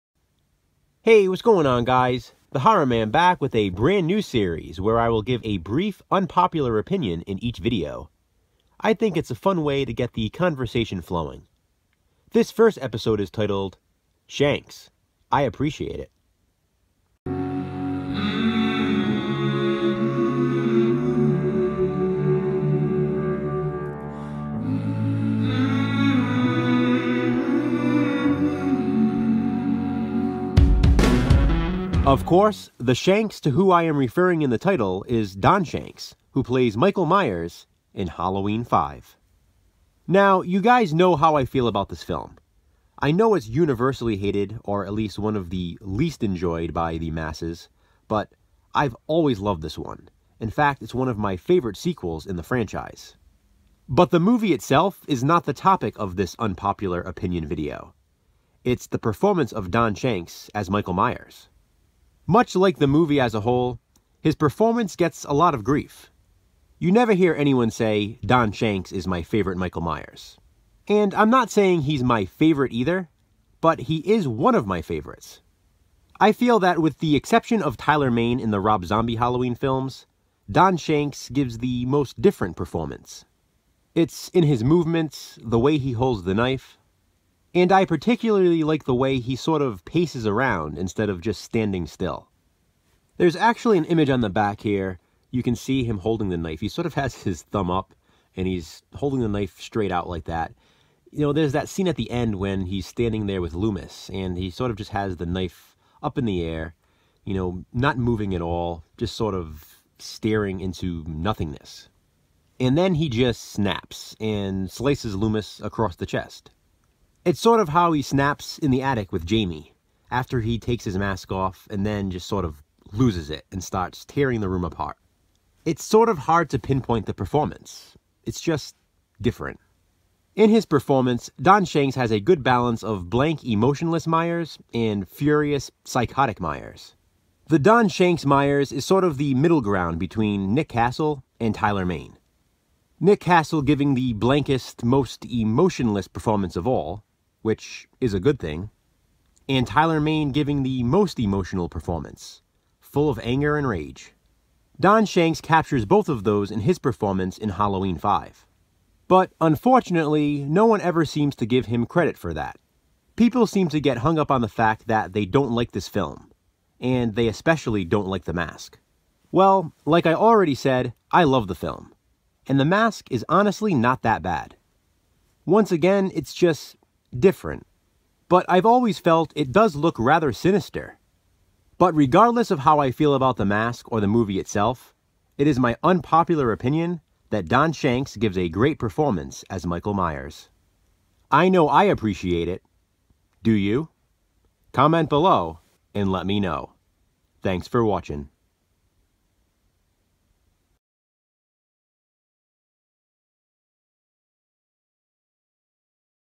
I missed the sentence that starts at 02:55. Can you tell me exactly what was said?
Once again, it's just different, but I've always felt it does look rather sinister.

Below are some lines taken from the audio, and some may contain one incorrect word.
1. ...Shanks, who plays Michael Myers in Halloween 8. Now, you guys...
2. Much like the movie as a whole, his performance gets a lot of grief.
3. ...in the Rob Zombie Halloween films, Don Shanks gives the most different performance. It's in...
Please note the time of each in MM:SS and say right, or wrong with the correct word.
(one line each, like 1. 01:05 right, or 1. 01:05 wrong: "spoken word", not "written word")
1. 00:35 wrong: "5", not "8"
2. 01:02 right
3. 01:18 right.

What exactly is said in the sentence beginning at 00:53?
But the movie itself is not the topic of this unpopular opinion video.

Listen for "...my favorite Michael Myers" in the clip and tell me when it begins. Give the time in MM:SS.
01:09.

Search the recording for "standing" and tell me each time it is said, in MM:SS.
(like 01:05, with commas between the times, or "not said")
01:31, 01:42.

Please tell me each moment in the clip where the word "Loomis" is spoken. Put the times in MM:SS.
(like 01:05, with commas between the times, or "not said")
01:43, 01:55.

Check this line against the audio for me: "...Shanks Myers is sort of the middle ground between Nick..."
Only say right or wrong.
right.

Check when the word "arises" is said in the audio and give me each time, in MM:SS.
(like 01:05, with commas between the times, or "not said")
not said.